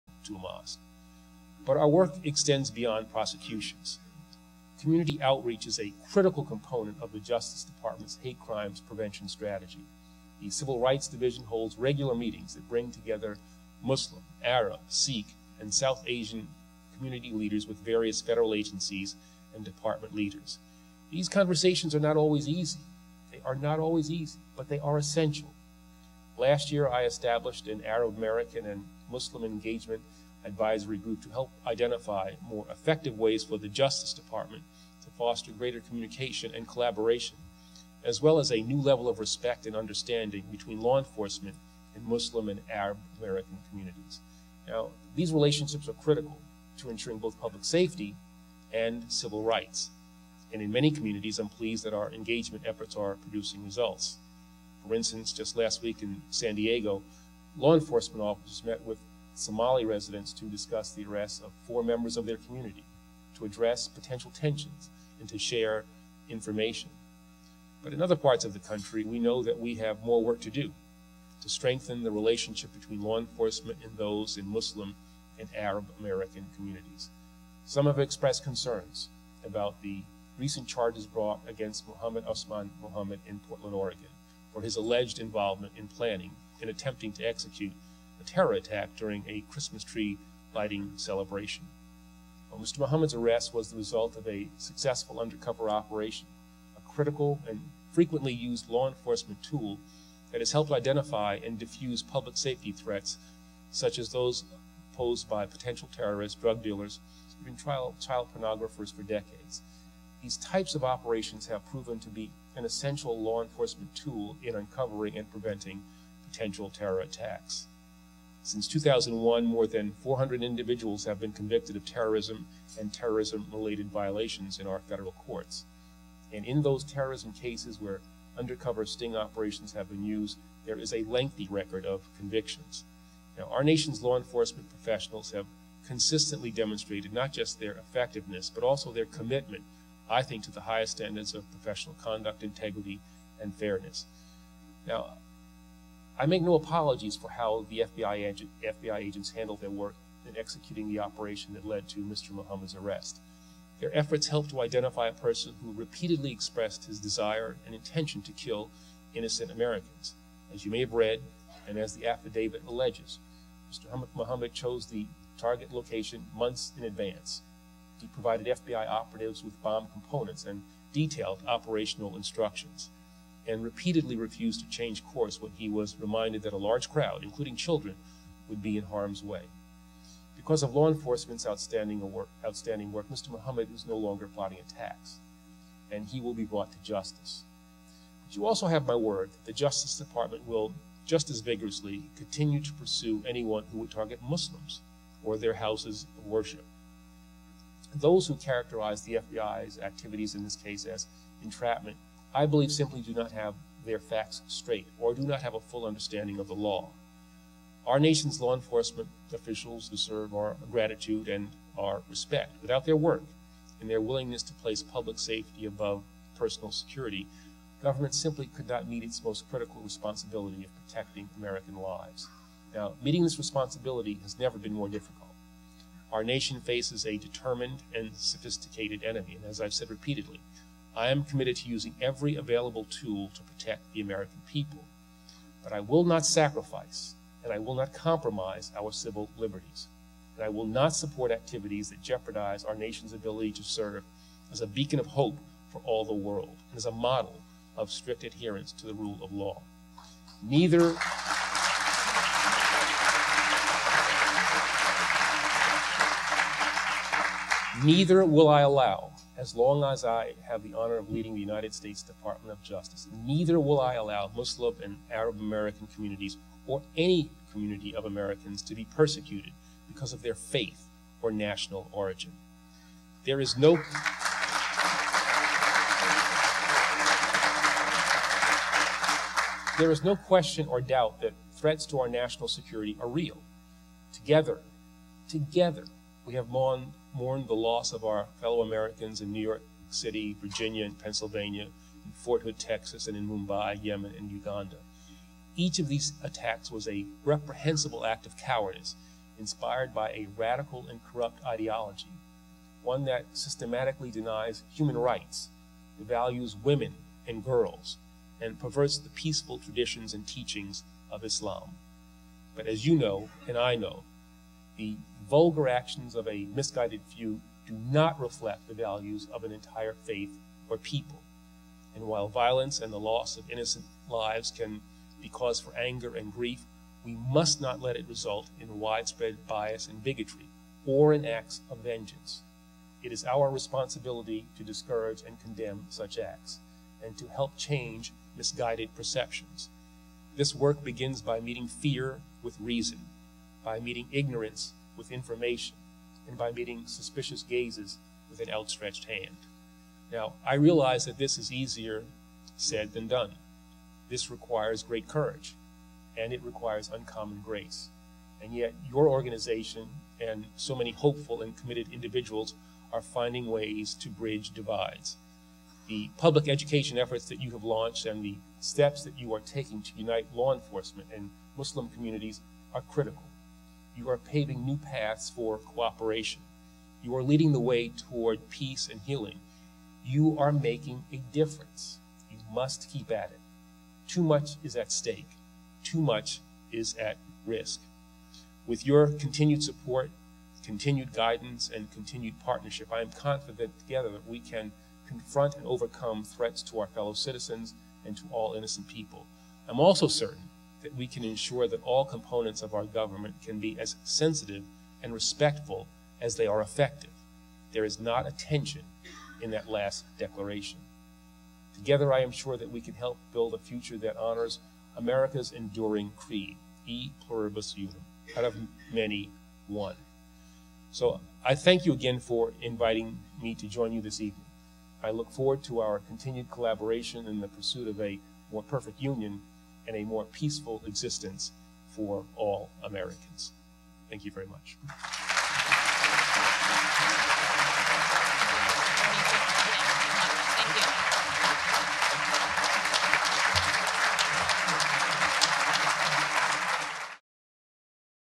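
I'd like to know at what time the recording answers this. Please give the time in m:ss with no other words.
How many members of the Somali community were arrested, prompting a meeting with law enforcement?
1:01.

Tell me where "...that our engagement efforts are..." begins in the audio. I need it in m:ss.
0:51.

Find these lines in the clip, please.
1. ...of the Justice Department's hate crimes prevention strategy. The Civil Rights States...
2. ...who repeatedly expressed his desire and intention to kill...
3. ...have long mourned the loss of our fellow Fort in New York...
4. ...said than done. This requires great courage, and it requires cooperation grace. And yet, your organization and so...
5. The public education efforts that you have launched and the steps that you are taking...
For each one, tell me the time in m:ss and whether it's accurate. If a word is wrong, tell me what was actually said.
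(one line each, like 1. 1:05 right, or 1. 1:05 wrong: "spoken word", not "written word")
1. 0:07 wrong: "Division", not "States"
2. 2:35 right
3. 4:46 wrong: "Americans", not "Fort"
4. 5:52 wrong: "uncommon", not "cooperation"
5. 6:05 right.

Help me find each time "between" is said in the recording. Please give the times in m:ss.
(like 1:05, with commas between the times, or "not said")
0:40, 1:12.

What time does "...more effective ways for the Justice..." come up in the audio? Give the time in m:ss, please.
0:32.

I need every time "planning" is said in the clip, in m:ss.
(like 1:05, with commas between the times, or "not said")
1:25.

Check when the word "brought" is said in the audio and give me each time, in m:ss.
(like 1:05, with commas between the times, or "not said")
1:21, 3:06.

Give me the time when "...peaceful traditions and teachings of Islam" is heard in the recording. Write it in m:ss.
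5:09.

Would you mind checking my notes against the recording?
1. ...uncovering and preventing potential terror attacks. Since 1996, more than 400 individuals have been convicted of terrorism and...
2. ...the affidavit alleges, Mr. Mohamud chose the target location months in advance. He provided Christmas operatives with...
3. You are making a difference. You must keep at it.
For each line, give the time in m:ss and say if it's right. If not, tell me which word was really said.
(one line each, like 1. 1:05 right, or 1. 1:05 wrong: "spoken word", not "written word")
1. 1:54 wrong: "2001", not "1996"
2. 2:41 wrong: "FBI", not "Christmas"
3. 6:20 right.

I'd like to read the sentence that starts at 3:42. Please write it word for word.
Now, meeting this responsibility has never been more difficult.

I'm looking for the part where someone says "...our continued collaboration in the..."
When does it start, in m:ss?
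7:05.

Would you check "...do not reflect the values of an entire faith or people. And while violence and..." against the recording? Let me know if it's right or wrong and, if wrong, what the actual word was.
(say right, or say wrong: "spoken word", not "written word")
right.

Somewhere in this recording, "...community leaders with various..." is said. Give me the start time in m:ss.
0:16.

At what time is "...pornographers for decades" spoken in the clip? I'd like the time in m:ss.
1:48.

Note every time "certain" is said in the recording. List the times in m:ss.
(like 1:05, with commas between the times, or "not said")
6:40.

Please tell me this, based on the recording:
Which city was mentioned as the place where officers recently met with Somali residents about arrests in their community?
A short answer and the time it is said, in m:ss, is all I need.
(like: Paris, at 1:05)
San Diego, at 0:56.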